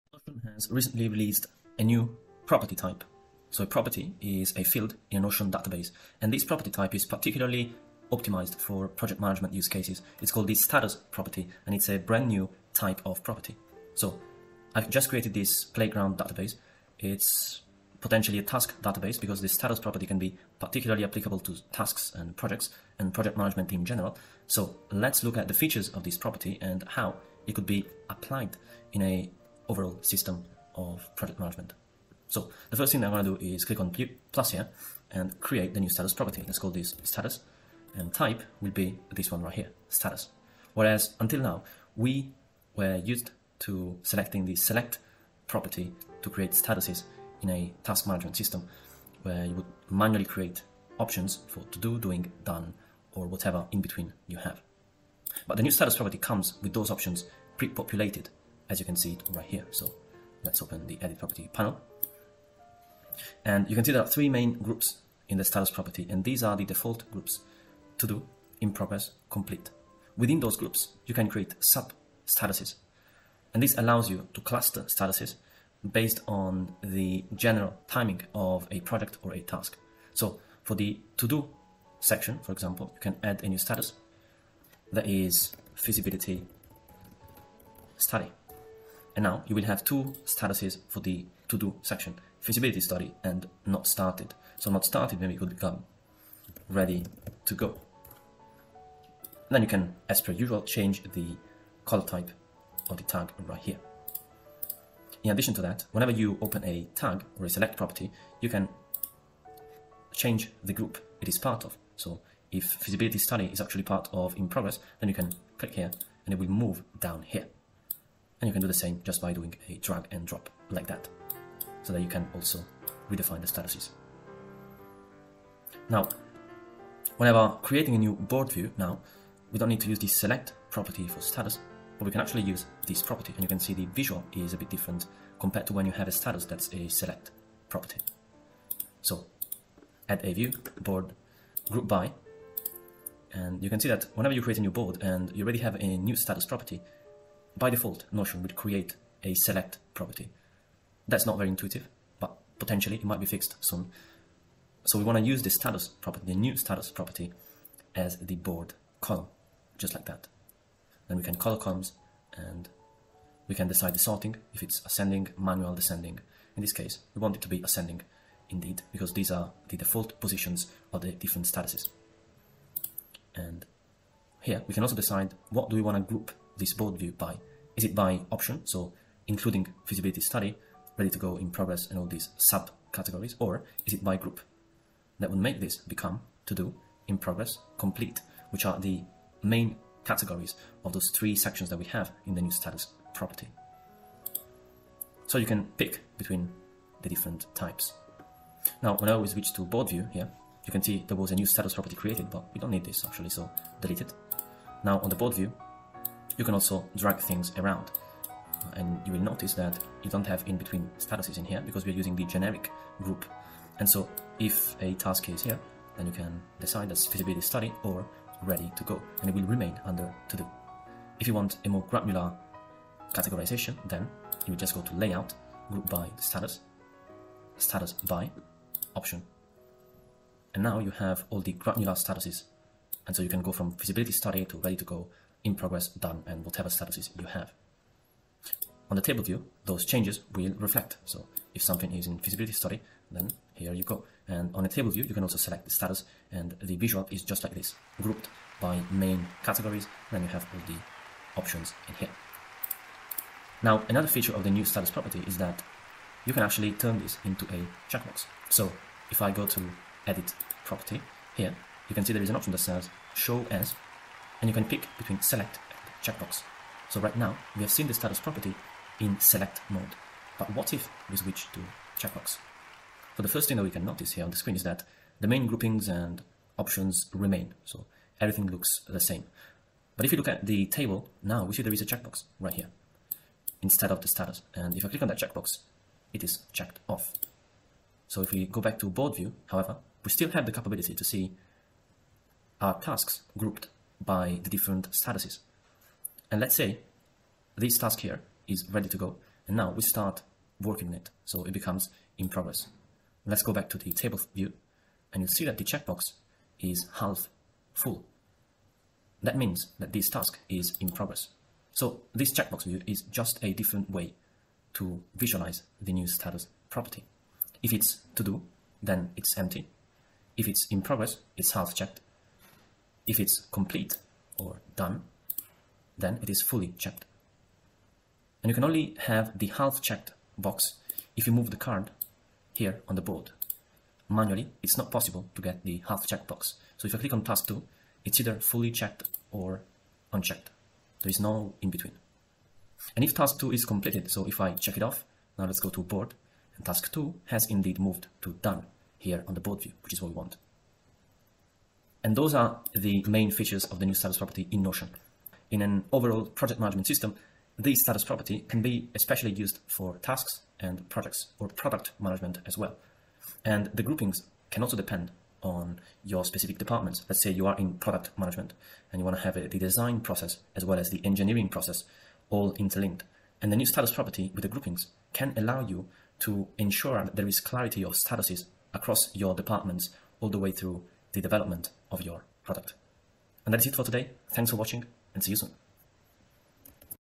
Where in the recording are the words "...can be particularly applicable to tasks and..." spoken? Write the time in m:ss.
0:20.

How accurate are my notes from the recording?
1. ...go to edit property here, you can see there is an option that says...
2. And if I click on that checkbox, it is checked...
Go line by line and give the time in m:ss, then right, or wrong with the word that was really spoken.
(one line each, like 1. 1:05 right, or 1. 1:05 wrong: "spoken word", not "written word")
1. 4:19 right
2. 4:44 right.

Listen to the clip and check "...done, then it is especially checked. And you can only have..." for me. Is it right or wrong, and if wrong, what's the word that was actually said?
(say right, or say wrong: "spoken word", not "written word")
wrong: "fully", not "especially".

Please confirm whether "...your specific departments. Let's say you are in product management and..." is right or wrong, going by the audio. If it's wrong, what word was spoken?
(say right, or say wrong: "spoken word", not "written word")
right.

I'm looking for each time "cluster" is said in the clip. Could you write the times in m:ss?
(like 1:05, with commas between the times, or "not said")
1:14.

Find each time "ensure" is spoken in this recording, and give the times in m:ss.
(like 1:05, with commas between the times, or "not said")
6:16.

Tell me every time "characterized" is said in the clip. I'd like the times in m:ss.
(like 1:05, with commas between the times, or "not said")
not said.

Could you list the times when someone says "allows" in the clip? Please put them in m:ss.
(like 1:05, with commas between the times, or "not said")
1:13, 6:15.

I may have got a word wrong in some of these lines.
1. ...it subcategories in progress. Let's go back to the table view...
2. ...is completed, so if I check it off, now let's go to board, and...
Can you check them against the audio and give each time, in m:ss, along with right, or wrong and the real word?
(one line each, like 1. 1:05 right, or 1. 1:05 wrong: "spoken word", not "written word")
1. 5:01 wrong: "becomes", not "subcategories"
2. 5:43 right.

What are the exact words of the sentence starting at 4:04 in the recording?
And on the table view, you can also select the status and the visual is just like this, grouped by main categories.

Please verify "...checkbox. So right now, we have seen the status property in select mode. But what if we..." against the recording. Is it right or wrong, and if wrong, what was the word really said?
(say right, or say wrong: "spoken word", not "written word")
right.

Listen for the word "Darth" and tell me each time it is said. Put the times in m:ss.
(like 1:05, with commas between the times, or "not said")
not said.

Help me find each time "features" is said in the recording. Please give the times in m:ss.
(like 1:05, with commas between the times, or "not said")
0:25, 4:14, 5:53.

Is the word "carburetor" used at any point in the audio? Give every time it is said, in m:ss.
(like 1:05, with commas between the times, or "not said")
not said.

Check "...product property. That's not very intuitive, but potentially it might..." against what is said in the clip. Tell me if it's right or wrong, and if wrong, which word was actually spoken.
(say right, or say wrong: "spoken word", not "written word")
wrong: "select", not "product".